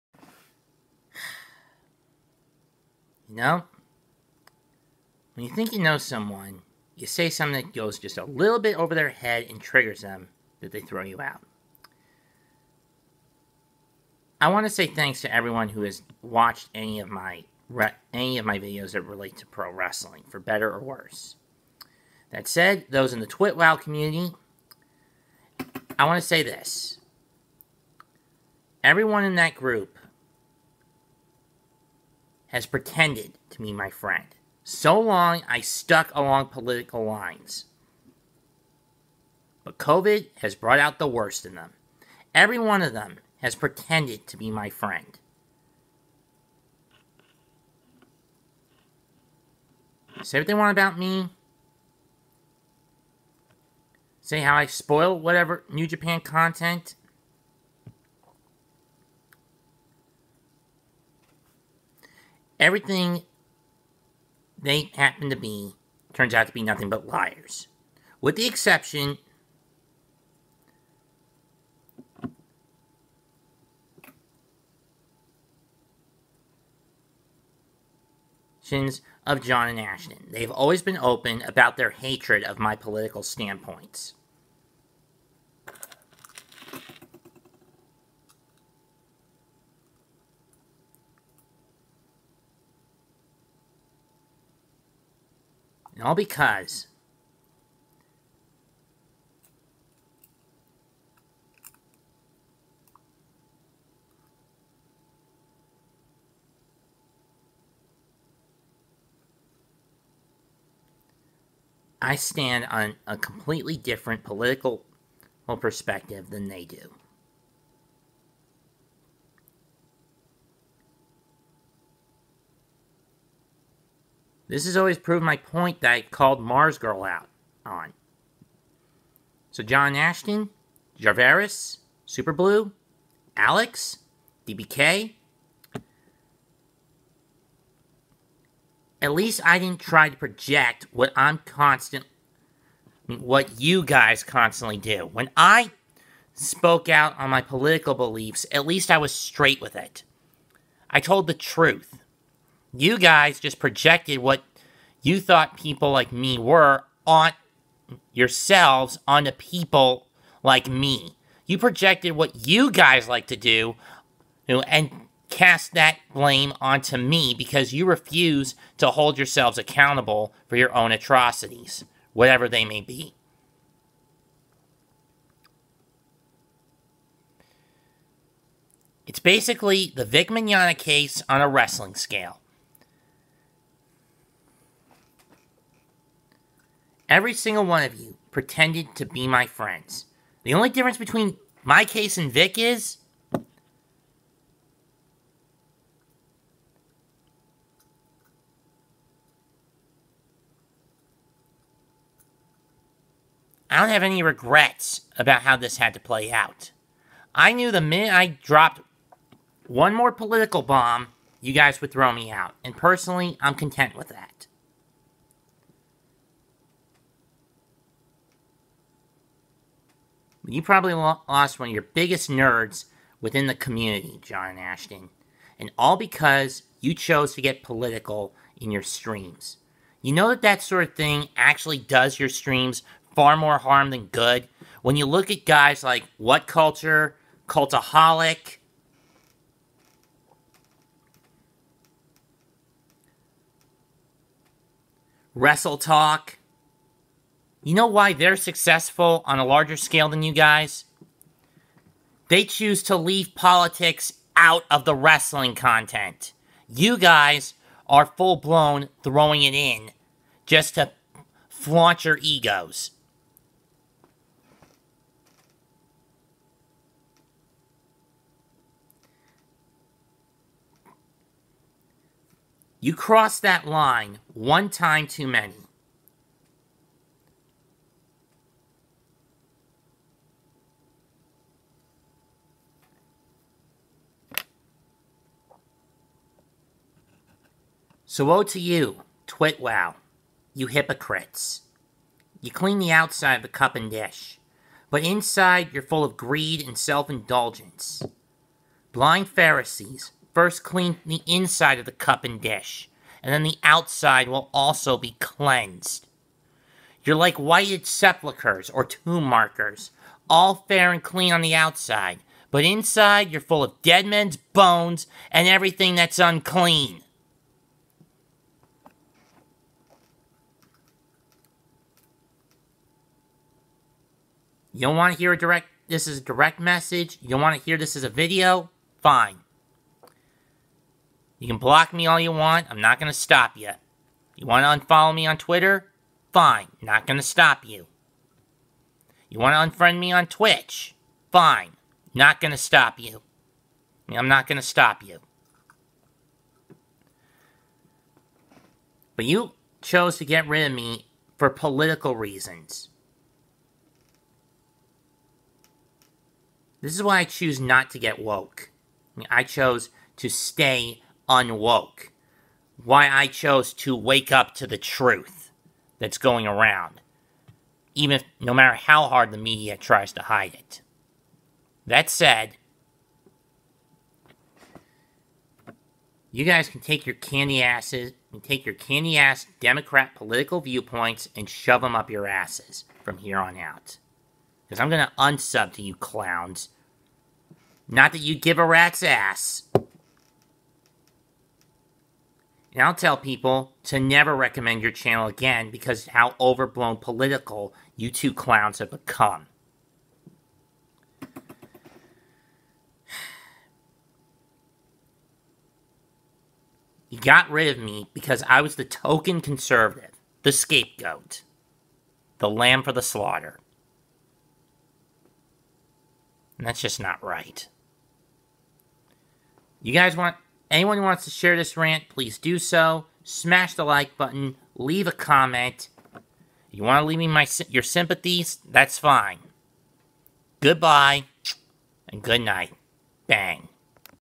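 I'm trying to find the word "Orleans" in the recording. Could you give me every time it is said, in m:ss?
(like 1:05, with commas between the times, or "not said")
not said.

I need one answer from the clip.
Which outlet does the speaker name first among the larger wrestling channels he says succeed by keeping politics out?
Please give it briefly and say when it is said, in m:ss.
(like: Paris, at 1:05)
What Culture, at 3:56.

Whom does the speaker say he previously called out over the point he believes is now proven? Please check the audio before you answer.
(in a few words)
Mars Girl.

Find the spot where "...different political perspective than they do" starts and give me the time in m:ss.
1:53.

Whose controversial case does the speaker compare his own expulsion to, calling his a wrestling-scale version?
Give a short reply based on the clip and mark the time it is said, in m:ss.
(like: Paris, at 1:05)
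Vic Mignogna, at 3:00.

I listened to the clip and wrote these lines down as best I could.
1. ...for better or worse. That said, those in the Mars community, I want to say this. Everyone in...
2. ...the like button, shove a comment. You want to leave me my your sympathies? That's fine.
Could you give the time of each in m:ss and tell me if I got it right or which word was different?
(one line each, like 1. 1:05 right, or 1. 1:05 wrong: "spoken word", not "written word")
1. 0:20 wrong: "TwitWow", not "Mars"
2. 7:03 wrong: "leave", not "shove".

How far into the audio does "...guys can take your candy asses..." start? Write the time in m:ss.
6:16.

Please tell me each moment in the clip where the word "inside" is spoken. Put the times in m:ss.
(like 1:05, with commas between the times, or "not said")
4:55, 5:01, 5:12.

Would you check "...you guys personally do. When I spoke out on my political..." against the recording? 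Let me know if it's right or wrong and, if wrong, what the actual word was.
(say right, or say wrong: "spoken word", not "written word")
wrong: "constantly", not "personally".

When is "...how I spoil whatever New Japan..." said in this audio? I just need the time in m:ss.
0:54.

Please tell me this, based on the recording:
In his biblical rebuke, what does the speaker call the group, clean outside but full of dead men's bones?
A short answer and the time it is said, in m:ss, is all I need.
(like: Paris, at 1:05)
Whited sepulchres, at 5:07.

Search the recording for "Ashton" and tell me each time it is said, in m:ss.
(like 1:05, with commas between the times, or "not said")
1:19, 2:09, 3:44.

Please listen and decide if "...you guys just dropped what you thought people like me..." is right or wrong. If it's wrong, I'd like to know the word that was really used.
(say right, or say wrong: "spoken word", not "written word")
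wrong: "projected", not "dropped".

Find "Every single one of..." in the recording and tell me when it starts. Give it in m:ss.
3:07.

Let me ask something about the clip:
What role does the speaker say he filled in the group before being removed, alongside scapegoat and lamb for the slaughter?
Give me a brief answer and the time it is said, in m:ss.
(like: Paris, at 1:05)
Token conservative, at 6:48.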